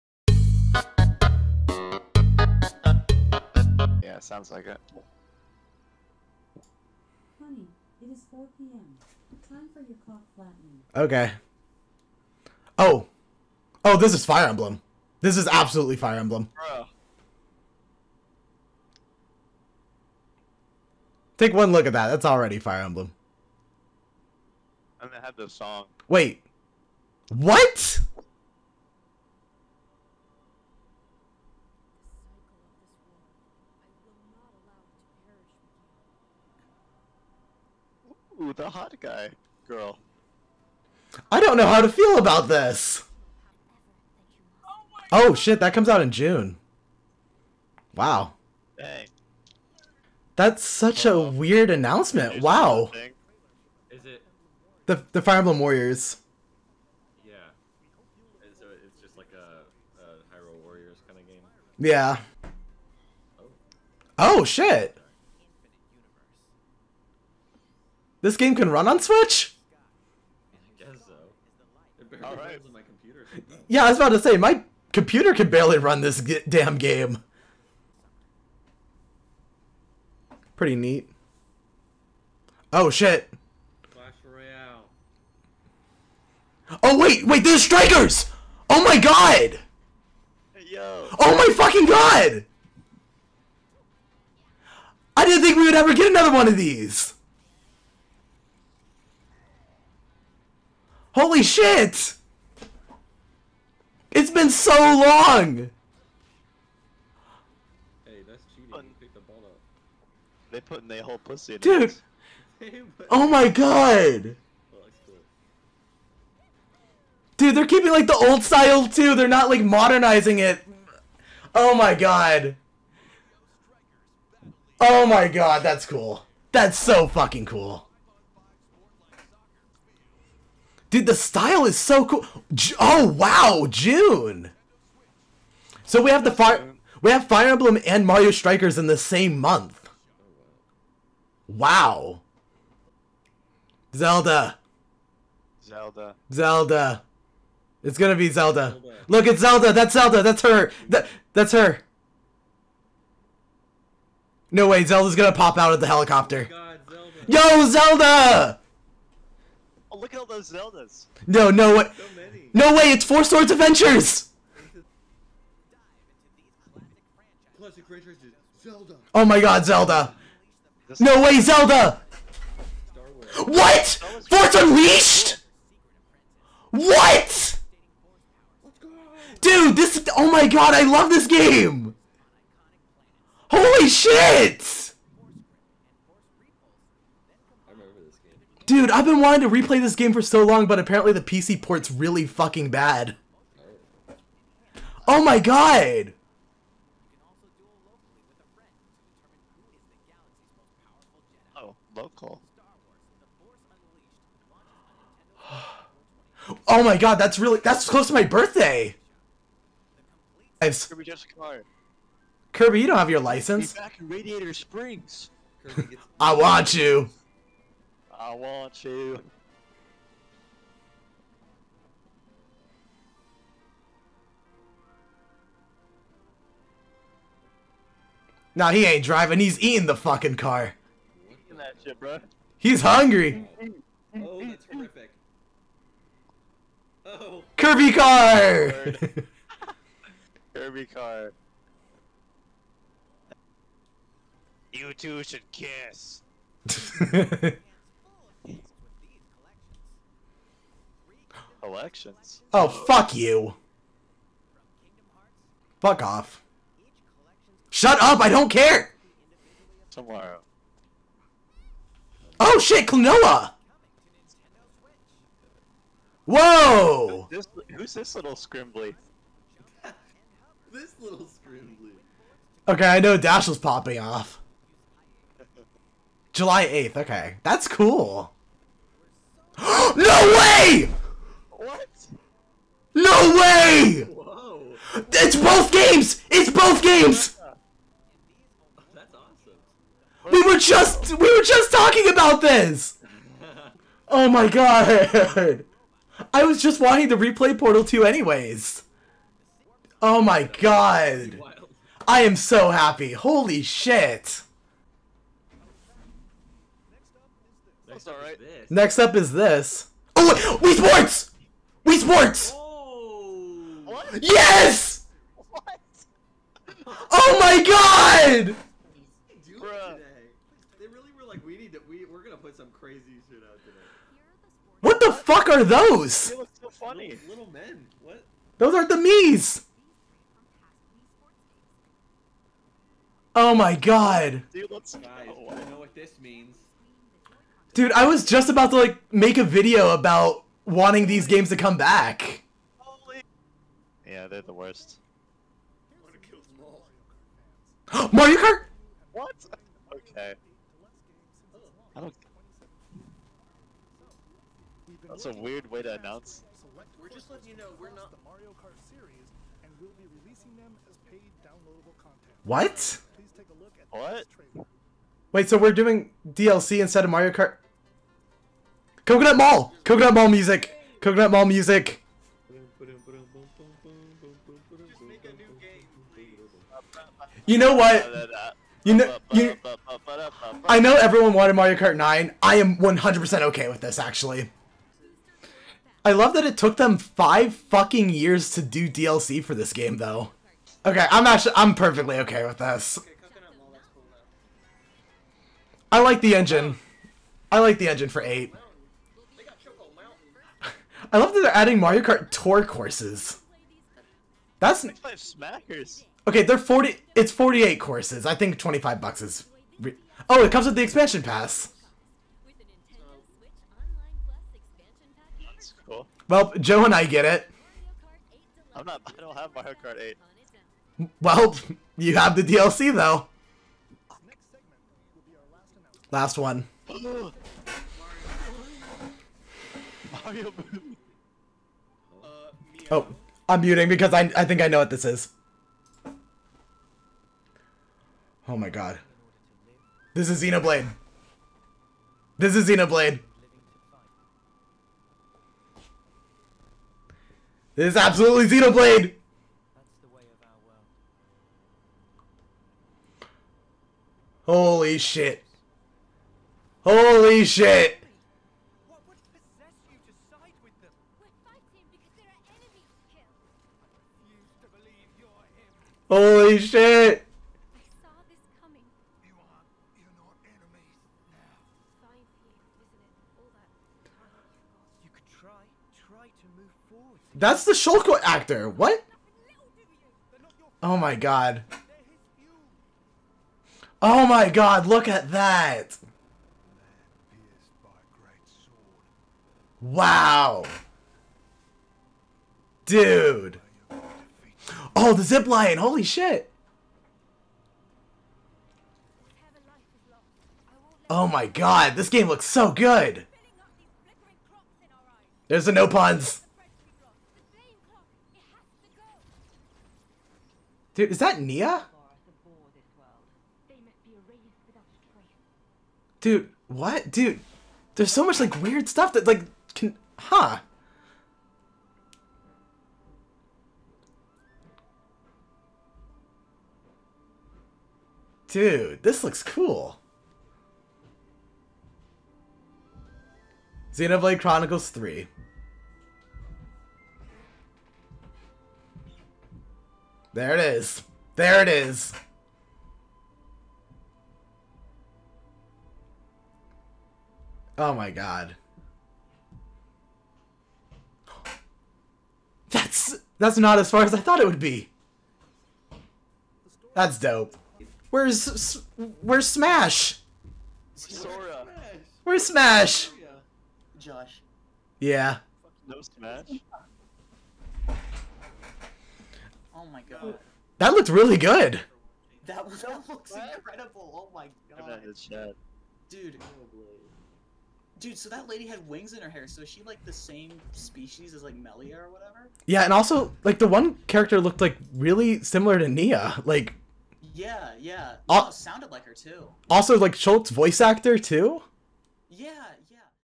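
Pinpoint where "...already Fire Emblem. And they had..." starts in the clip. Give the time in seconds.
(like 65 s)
22 s.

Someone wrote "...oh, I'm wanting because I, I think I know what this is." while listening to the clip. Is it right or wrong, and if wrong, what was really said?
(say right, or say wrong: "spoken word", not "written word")
wrong: "muting", not "wanting".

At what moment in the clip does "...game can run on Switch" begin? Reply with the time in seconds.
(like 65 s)
68 s.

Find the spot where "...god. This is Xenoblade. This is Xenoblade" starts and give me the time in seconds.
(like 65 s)
438 s.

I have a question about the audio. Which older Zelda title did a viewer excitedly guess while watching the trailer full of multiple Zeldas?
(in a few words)
Four Swords Adventures.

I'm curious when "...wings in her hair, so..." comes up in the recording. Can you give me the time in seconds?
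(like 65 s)
578 s.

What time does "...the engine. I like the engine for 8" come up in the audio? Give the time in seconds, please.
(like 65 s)
396 s.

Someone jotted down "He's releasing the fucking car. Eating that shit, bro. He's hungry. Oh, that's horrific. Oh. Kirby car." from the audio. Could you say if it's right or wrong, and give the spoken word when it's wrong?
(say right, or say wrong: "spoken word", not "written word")
wrong: "eating", not "releasing".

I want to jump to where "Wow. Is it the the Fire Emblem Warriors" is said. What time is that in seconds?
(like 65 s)
52 s.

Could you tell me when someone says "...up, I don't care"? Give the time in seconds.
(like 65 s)
258 s.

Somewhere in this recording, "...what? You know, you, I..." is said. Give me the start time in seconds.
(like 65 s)
377 s.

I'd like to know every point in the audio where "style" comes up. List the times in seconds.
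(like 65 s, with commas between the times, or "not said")
118 s, 131 s.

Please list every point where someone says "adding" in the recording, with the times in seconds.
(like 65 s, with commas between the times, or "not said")
401 s.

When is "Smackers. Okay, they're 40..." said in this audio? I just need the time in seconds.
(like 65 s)
404 s.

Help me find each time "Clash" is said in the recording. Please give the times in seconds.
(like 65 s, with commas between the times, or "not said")
83 s.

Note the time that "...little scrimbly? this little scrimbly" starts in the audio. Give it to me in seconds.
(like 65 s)
268 s.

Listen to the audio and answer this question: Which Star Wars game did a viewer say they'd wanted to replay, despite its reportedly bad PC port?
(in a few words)
Force Unleashed.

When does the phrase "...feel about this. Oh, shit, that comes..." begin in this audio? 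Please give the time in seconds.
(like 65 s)
41 s.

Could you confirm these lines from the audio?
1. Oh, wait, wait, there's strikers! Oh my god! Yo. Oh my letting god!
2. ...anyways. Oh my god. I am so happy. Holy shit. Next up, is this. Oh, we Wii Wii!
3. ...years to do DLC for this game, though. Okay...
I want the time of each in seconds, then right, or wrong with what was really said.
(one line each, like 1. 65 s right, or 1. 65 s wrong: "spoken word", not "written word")
1. 86 s wrong: "fucking", not "letting"
2. 298 s wrong: "Sports", not "Wii"
3. 388 s right.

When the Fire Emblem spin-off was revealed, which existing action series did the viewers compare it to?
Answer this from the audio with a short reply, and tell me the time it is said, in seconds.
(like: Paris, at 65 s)
Hyrule Warriors, at 60 s.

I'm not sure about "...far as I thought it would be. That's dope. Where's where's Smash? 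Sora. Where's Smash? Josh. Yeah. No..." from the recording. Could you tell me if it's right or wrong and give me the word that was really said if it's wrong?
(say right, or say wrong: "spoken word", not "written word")
right.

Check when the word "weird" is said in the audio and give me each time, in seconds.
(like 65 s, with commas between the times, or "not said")
51 s, 355 s, 518 s.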